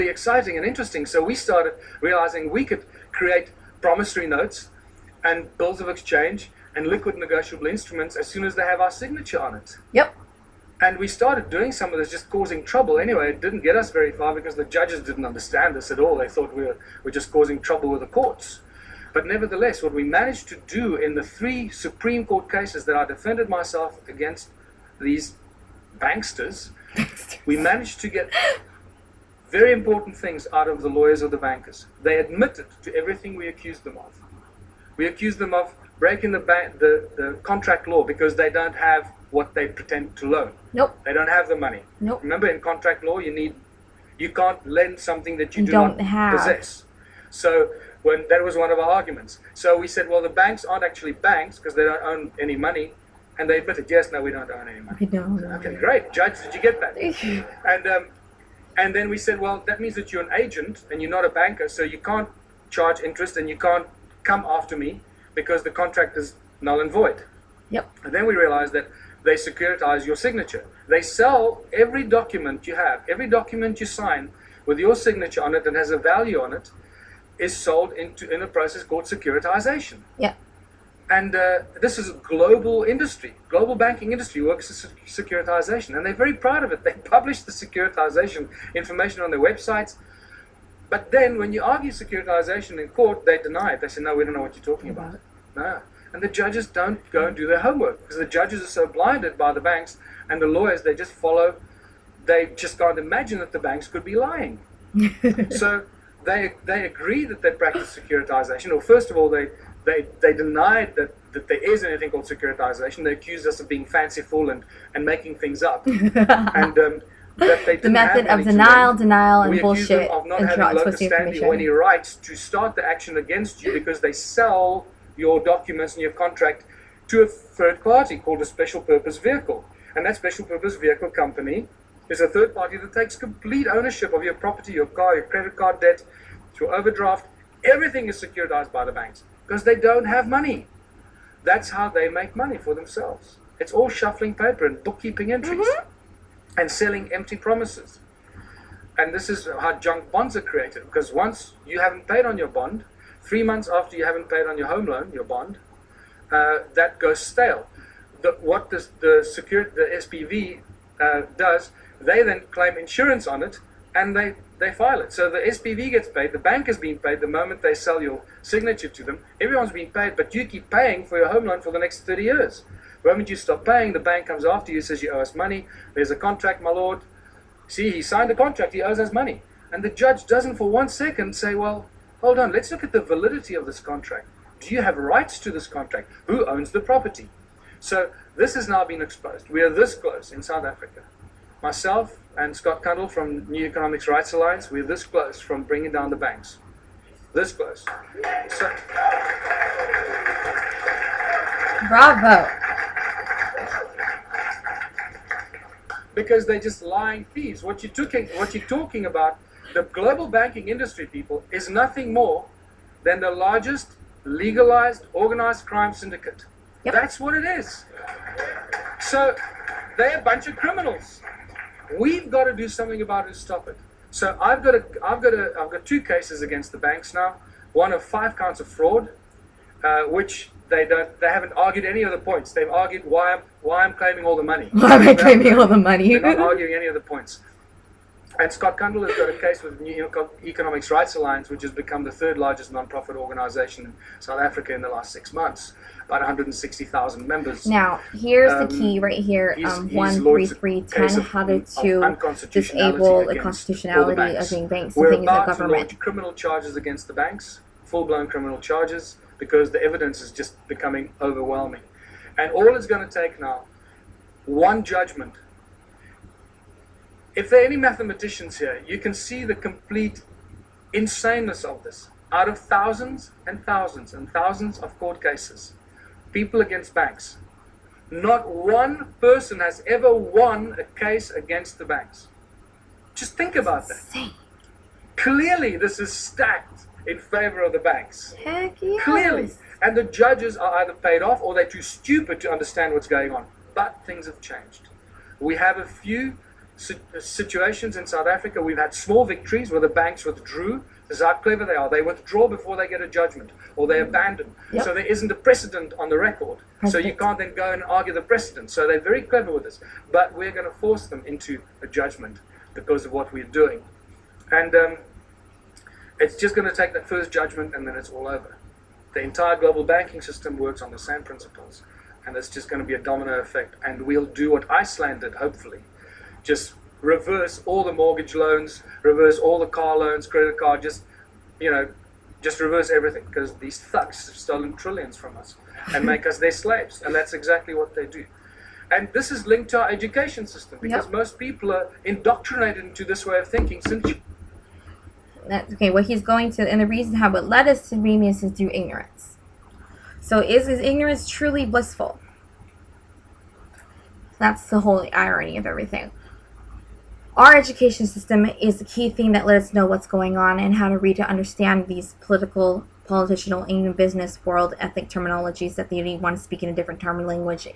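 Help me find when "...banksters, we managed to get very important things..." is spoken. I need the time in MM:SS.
00:25.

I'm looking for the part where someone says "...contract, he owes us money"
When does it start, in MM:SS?
02:58.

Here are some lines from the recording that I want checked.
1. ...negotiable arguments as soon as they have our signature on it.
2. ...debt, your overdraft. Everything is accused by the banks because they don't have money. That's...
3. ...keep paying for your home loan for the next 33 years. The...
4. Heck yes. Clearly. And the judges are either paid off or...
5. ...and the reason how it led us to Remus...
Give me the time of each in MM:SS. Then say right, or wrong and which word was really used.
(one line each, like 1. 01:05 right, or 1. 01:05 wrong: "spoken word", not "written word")
1. 00:07 wrong: "instruments", not "arguments"
2. 02:15 wrong: "securitized", not "accused"
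3. 02:50 wrong: "30", not "33"
4. 04:48 right
5. 05:46 right.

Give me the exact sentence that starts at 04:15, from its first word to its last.
to launch criminal charges against the banks, full-blown criminal charges, because the evidence is just becoming overwhelming.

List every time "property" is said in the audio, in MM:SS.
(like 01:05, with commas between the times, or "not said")
02:14, 03:06.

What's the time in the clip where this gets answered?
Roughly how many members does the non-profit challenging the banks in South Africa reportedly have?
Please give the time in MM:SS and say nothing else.
04:06.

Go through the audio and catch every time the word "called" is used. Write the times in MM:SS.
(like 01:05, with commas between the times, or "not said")
01:18, 01:52, 02:08.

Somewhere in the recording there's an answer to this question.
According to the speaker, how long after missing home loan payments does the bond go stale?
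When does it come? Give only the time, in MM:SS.
02:33.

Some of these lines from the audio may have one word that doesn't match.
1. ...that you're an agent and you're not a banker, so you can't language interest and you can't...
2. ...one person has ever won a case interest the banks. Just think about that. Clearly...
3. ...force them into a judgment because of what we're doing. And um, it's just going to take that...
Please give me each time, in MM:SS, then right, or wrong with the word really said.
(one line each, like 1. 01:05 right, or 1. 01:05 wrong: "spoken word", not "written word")
1. 00:59 wrong: "charge", not "language"
2. 04:38 wrong: "against", not "interest"
3. 05:10 right.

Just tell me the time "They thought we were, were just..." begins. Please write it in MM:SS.
00:16.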